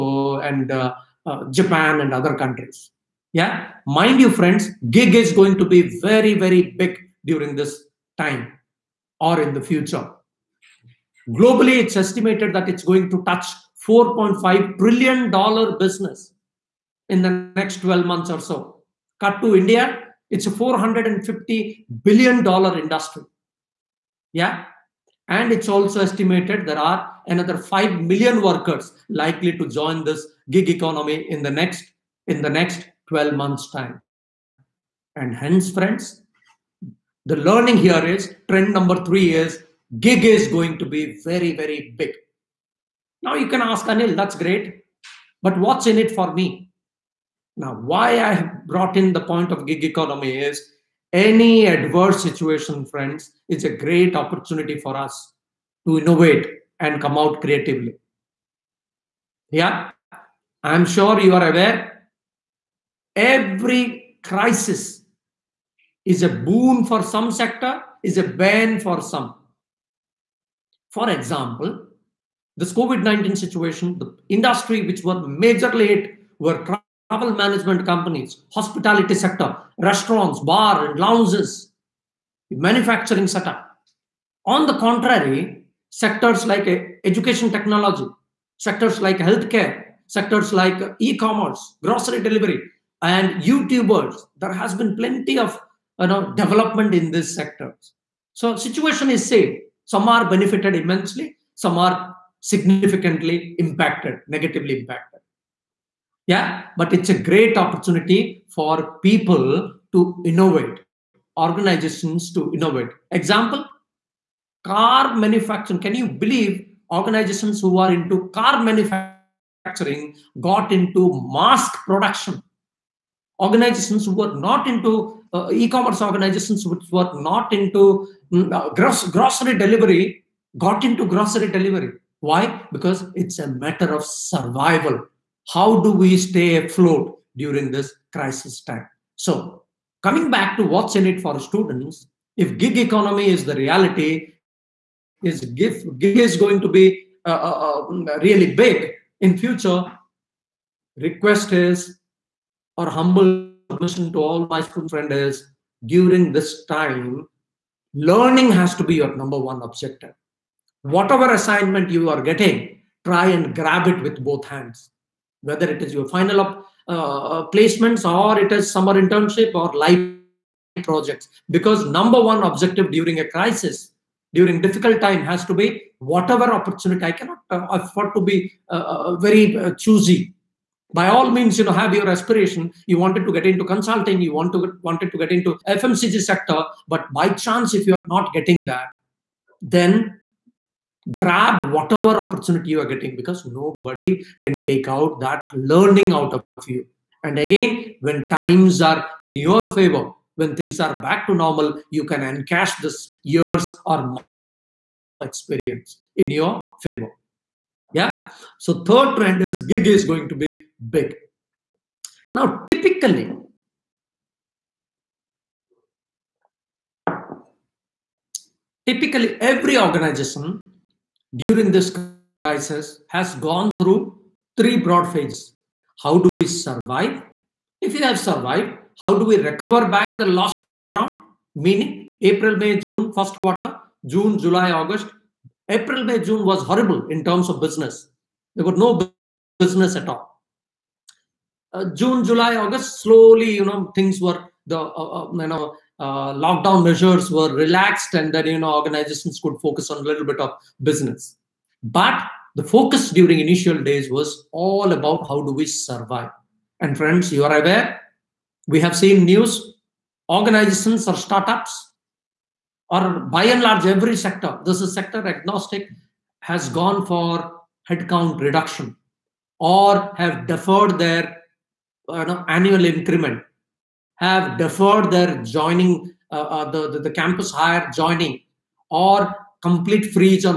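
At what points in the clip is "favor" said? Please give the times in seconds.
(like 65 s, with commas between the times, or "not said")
199 s, 206 s.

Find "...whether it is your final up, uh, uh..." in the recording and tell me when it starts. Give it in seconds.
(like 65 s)
165 s.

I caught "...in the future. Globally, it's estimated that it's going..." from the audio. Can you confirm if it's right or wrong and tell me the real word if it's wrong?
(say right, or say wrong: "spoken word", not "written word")
right.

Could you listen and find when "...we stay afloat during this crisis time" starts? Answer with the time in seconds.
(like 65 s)
135 s.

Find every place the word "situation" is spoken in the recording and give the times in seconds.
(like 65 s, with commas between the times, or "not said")
52 s, 73 s, 98 s.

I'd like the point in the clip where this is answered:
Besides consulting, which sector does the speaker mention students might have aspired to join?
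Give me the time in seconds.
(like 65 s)
185 s.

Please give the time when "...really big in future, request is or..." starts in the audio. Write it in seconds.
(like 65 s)
148 s.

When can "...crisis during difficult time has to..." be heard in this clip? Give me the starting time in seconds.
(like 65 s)
173 s.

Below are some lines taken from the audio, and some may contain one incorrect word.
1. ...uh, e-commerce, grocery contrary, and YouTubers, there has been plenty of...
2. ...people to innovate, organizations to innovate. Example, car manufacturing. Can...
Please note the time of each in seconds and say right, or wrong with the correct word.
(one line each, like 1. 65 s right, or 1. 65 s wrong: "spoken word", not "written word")
1. 90 s wrong: "delivery", not "contrary"
2. 109 s right.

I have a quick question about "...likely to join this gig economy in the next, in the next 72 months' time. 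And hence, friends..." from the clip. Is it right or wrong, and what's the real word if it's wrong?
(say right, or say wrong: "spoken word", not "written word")
wrong: "12", not "72".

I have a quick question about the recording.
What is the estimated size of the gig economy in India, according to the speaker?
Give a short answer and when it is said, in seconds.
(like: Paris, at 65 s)
$450 billion, at 20 s.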